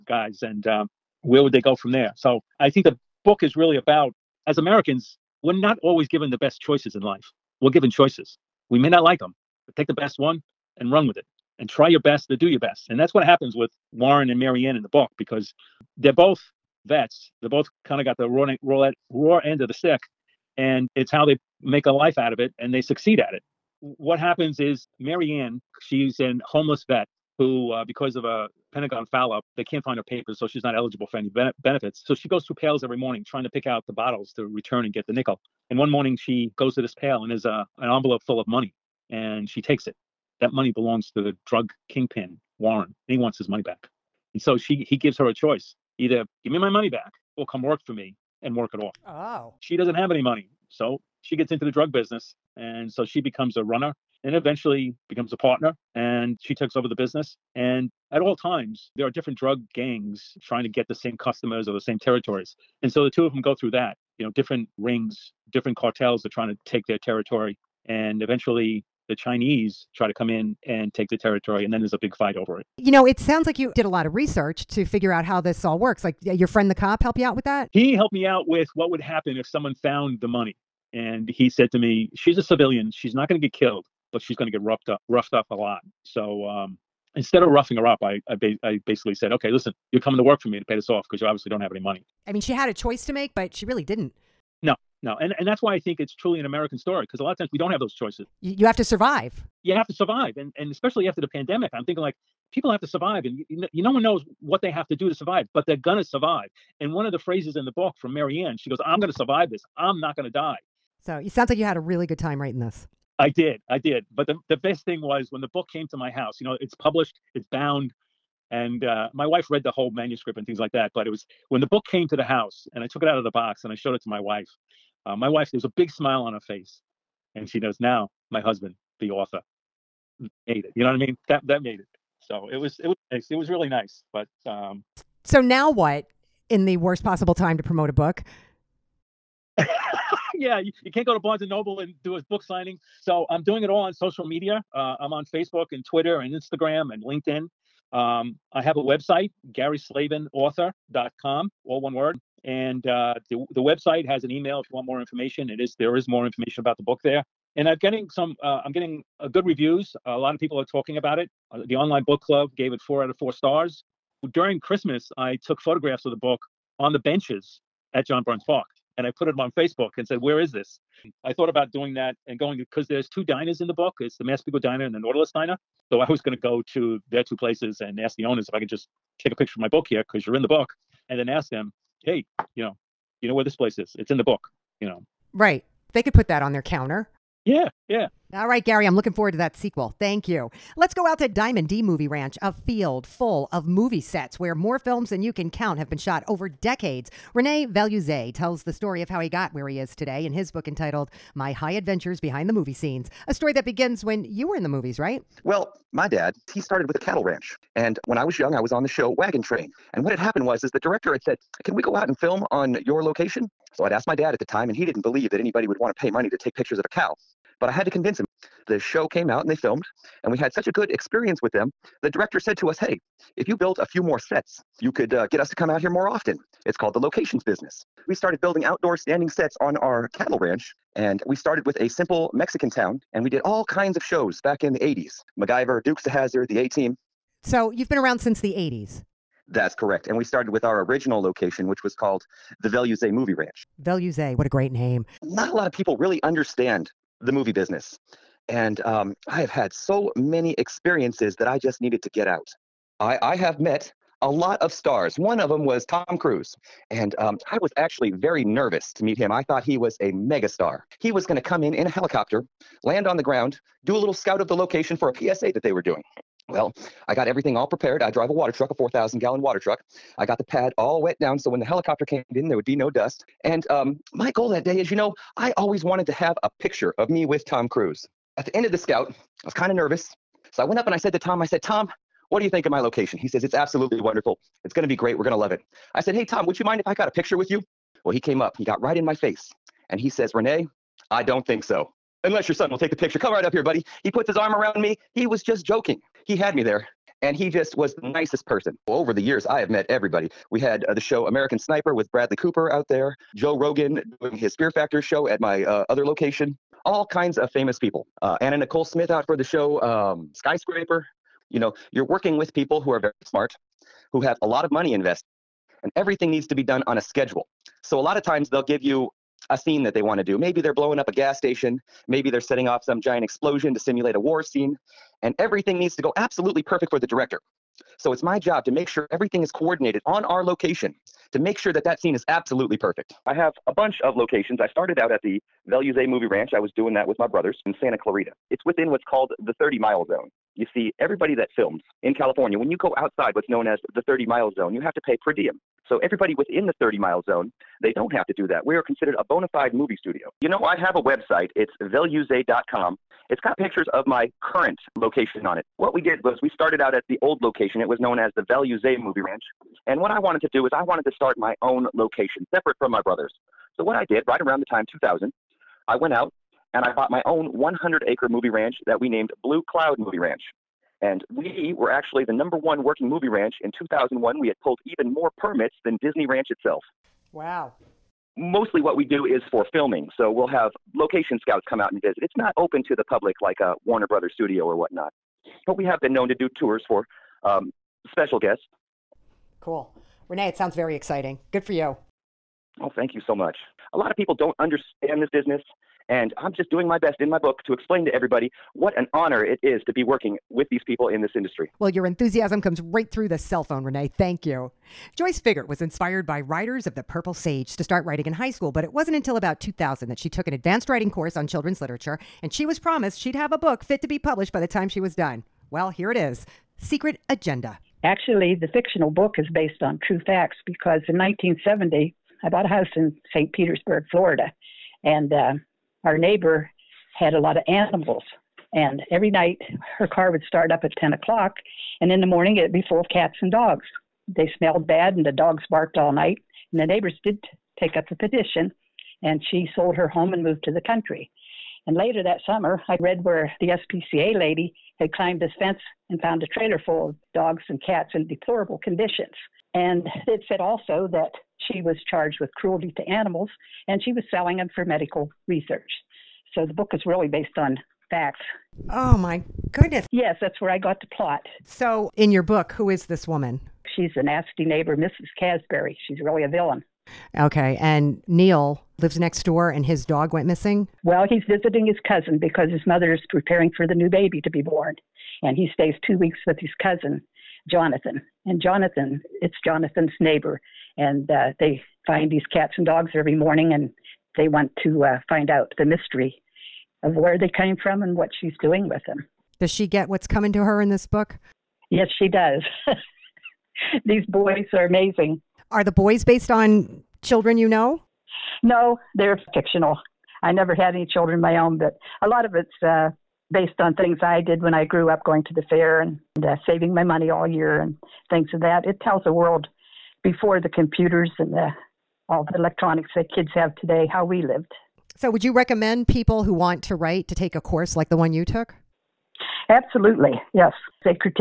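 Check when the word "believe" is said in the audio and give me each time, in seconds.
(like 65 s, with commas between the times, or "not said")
215 s.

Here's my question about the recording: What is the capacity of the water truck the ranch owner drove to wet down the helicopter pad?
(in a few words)
4,000 gallons.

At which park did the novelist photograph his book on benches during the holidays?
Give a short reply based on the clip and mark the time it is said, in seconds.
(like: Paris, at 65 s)
John Burns Park, at 168 s.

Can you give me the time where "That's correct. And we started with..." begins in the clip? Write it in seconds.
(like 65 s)
239 s.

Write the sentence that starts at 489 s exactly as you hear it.
Does she get what's coming to her in this book?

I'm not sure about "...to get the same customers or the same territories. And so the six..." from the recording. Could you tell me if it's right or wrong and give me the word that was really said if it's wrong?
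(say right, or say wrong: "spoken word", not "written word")
wrong: "two", not "six".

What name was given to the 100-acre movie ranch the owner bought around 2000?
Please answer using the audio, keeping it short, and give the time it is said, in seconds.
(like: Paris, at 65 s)
Blue Cloud Movie Ranch, at 369 s.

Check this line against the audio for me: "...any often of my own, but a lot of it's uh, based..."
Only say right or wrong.
wrong.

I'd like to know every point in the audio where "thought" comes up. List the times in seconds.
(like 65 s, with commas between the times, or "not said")
171 s, 259 s.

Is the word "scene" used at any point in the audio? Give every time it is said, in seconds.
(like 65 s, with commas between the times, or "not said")
202 s, 319 s, 324 s, 331 s.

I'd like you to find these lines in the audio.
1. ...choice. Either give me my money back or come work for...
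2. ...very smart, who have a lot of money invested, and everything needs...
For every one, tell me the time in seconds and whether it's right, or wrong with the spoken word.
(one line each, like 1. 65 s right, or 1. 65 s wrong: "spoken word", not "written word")
1. 45 s right
2. 312 s right.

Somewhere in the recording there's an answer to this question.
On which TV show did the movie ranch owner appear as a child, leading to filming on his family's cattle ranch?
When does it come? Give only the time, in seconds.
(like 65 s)
209 s.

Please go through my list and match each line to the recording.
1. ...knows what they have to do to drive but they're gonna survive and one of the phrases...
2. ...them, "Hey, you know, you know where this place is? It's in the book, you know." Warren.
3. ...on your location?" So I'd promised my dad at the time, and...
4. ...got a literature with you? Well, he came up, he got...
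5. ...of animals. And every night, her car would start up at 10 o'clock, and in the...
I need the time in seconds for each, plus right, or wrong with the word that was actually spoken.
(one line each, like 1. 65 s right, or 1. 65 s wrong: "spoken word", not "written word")
1. 104 s wrong: "survive", not "drive"
2. 181 s wrong: "Right", not "Warren"
3. 212 s wrong: "asked", not "promised"
4. 286 s wrong: "picture", not "literature"
5. 427 s right.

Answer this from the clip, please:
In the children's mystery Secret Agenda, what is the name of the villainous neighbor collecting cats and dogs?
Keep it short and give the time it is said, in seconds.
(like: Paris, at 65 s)
Mrs. Casbury, at 464 s.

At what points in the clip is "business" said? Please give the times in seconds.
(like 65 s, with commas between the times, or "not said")
51 s, 56 s, 227 s, 247 s, 395 s.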